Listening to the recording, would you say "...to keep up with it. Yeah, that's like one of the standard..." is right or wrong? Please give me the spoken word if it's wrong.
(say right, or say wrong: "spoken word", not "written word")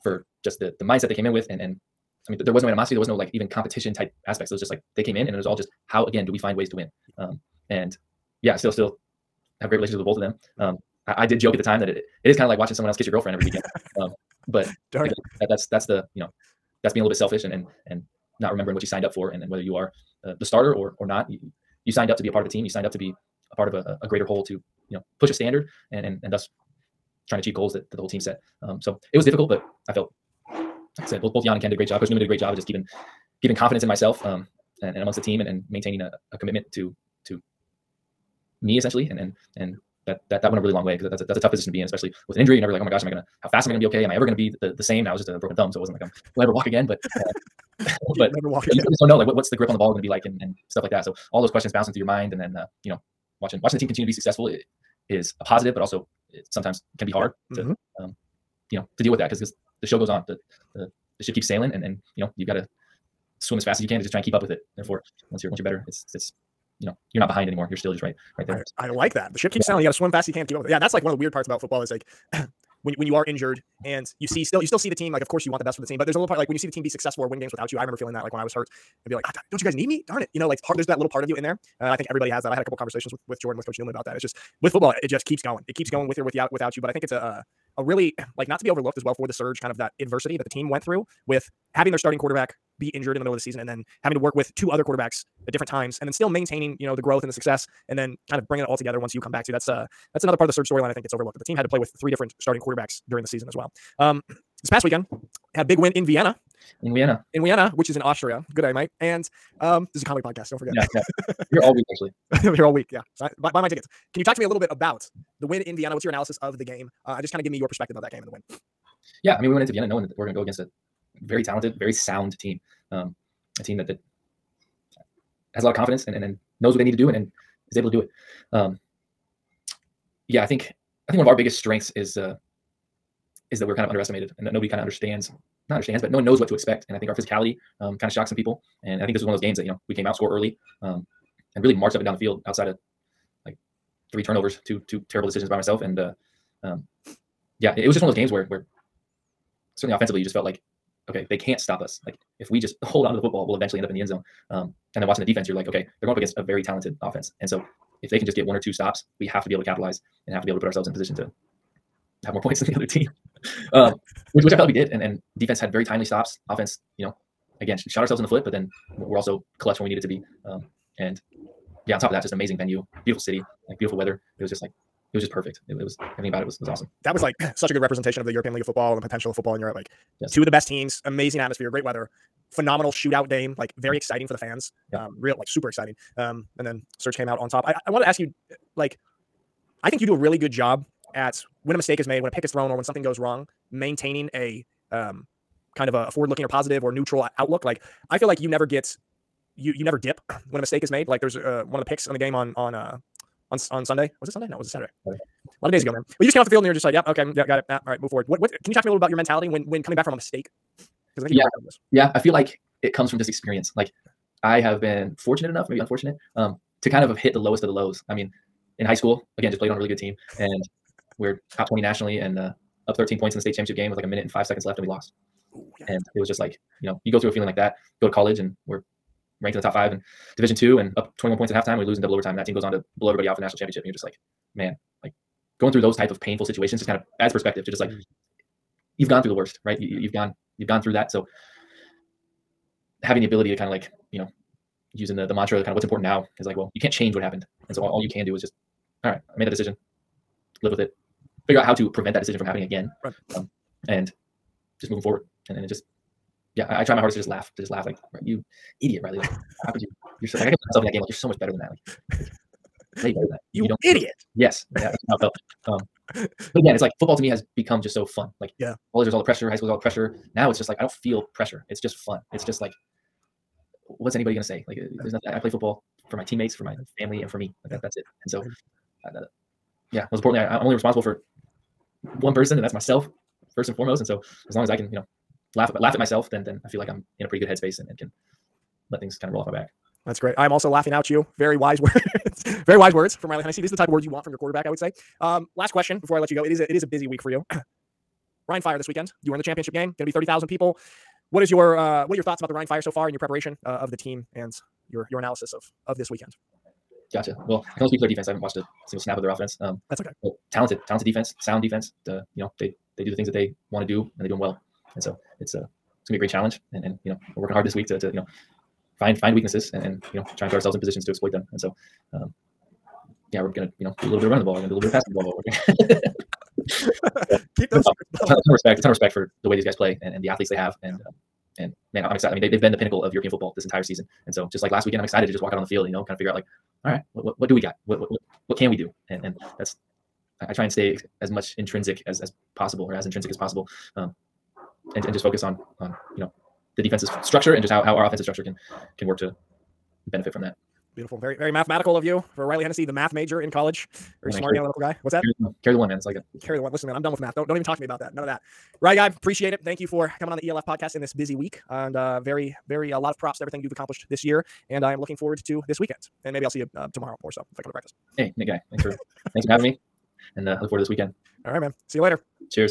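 wrong: "weird", not "standard".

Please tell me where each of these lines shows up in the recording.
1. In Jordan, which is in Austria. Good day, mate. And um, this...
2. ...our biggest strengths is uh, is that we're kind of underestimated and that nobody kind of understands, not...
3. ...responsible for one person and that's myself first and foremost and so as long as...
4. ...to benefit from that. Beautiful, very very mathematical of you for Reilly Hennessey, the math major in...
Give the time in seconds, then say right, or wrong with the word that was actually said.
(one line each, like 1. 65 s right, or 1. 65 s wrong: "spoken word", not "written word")
1. 107 s wrong: "Vienna", not "Jordan"
2. 131 s right
3. 280 s right
4. 349 s right.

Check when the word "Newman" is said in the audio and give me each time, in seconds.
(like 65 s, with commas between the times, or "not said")
83 s.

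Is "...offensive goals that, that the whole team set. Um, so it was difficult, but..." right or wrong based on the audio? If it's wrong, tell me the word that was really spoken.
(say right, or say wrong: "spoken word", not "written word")
wrong: "achieve", not "offensive".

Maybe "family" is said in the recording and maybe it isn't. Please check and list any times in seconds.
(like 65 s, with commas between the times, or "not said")
276 s.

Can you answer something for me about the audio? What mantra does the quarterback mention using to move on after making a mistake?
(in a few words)
What's important now.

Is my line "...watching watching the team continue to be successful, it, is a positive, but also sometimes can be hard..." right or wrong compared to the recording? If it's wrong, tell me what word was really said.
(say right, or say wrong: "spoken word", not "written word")
right.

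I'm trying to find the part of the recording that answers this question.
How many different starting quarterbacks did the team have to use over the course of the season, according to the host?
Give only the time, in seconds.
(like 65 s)
101 s.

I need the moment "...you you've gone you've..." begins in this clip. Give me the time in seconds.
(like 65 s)
239 s.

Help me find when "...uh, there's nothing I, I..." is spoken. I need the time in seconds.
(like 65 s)
274 s.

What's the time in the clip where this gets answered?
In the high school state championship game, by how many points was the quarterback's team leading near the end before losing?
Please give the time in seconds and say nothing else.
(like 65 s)
222 s.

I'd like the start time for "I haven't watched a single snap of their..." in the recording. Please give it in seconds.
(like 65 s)
308 s.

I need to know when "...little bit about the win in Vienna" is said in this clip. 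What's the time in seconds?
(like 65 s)
114 s.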